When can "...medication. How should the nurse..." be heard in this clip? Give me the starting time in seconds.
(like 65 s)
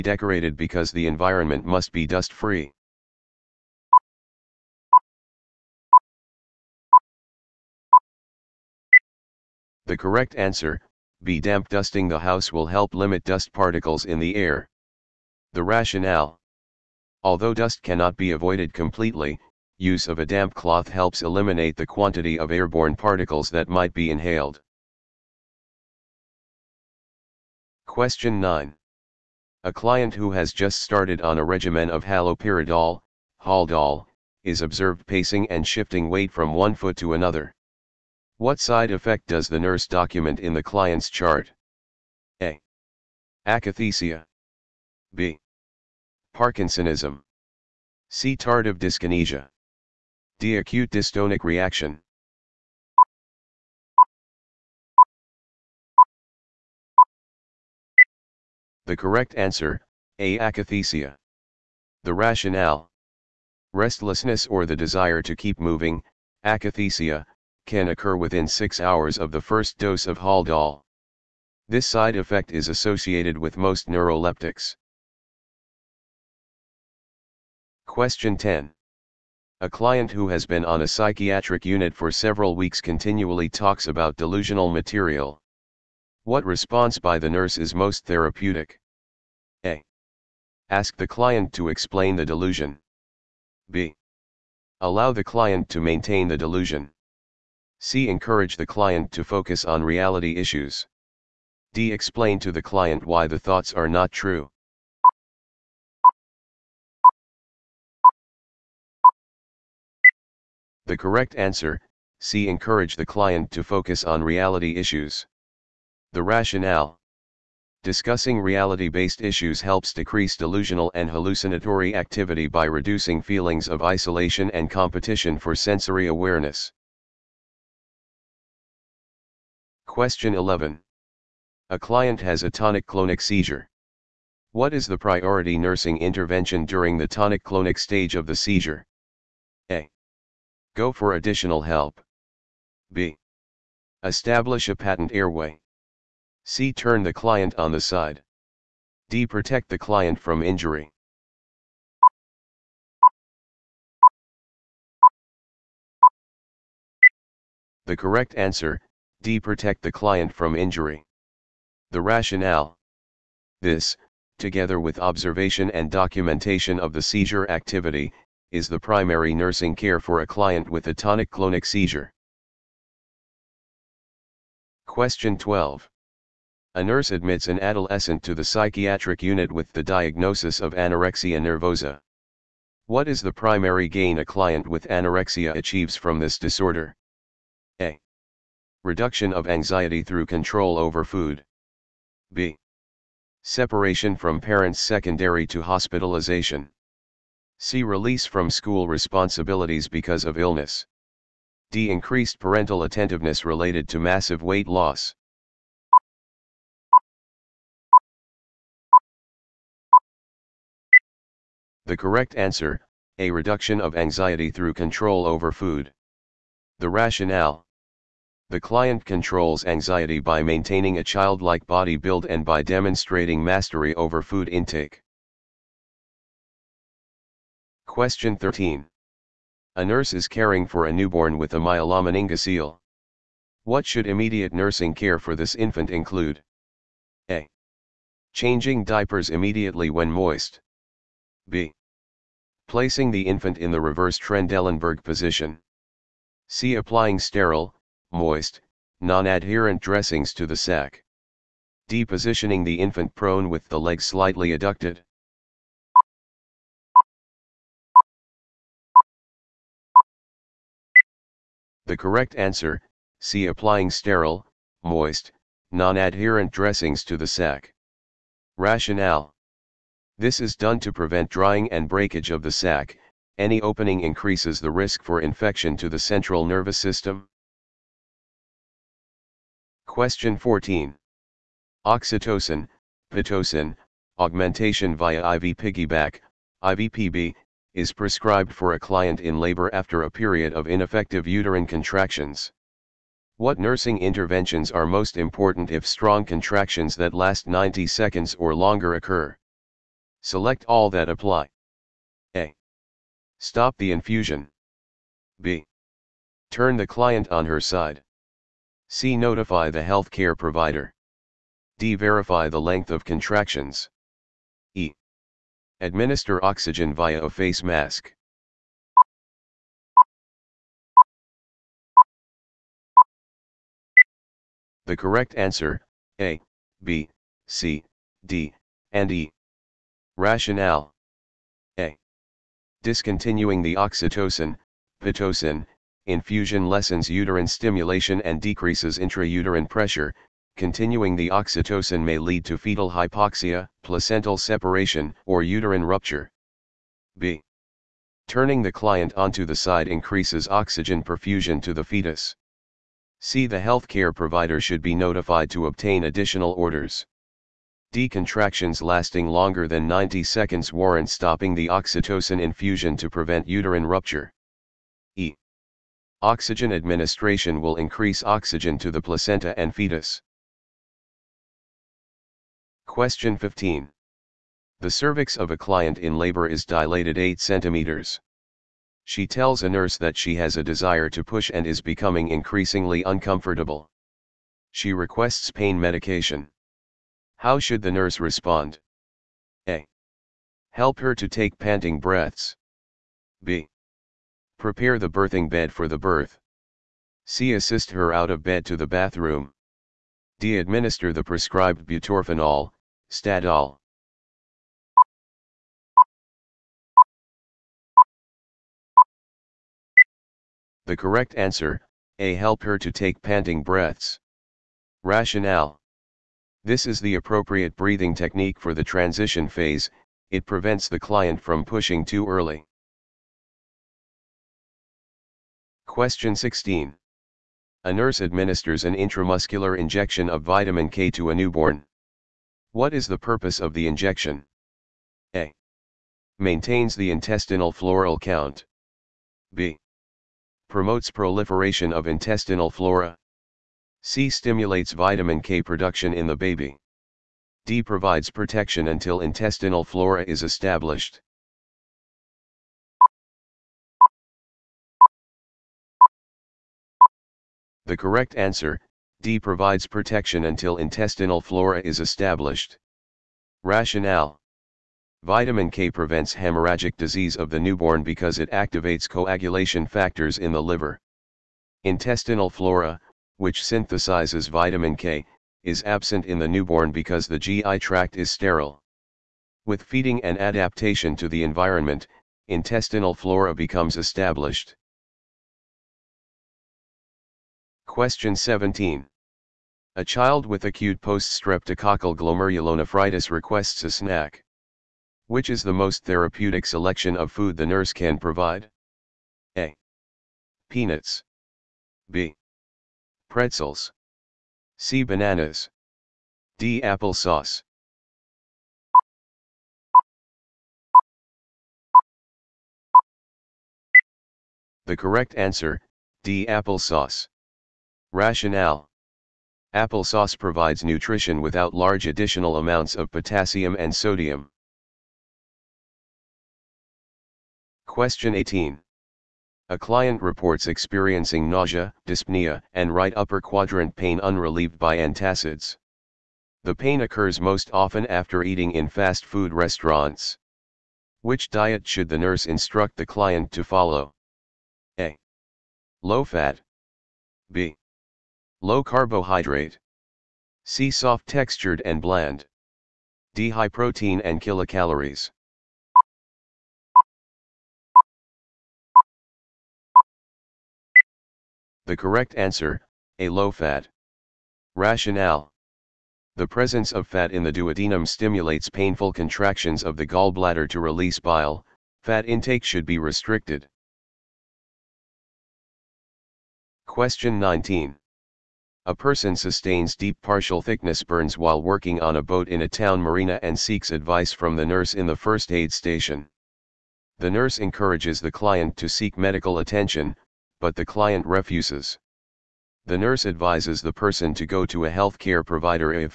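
385 s.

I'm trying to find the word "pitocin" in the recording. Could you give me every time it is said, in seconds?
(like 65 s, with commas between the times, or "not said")
283 s, 335 s.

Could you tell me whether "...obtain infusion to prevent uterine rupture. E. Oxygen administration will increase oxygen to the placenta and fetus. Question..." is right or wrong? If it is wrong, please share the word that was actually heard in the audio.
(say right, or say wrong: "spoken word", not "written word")
wrong: "oxytocin", not "obtain".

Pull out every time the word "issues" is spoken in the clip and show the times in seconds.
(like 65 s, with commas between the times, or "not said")
100 s, 114 s, 119 s.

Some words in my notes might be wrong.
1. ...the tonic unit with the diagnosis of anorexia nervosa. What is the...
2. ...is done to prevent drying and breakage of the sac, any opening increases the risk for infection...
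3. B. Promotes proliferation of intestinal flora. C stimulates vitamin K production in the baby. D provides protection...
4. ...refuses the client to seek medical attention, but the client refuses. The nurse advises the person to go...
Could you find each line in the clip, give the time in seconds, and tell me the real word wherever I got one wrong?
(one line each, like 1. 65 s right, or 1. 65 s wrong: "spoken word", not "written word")
1. 178 s wrong: "psychiatric", not "tonic"
2. 270 s right
3. 439 s right
4. 587 s wrong: "encourages", not "refuses".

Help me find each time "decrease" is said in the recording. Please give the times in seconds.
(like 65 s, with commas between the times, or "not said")
119 s, 338 s.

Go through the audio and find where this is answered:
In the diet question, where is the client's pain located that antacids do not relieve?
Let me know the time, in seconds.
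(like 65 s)
532 s.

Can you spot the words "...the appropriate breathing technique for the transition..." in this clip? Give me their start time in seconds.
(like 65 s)
416 s.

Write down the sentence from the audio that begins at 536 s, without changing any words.
The pain occurs most often after eating in fast food restaurants.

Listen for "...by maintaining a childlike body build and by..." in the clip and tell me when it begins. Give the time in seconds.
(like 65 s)
220 s.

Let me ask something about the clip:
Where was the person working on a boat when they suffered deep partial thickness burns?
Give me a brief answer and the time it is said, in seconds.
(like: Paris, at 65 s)
town marina, at 582 s.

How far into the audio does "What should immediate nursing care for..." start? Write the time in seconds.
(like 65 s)
233 s.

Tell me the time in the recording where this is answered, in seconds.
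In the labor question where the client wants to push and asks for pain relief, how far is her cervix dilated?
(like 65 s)
377 s.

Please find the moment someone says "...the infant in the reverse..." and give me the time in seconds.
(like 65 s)
243 s.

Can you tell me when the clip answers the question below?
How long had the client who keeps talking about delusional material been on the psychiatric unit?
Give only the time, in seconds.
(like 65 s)
82 s.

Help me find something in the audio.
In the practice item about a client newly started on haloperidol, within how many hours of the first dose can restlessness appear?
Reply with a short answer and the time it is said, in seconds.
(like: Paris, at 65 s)
6 hours, at 68 s.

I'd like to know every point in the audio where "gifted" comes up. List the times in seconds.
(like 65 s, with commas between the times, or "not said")
not said.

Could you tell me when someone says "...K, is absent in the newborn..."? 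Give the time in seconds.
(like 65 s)
474 s.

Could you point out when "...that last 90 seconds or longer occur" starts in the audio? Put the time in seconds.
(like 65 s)
296 s.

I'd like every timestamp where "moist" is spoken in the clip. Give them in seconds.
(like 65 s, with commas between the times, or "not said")
240 s, 248 s, 264 s.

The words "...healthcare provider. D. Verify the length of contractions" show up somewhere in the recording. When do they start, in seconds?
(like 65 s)
309 s.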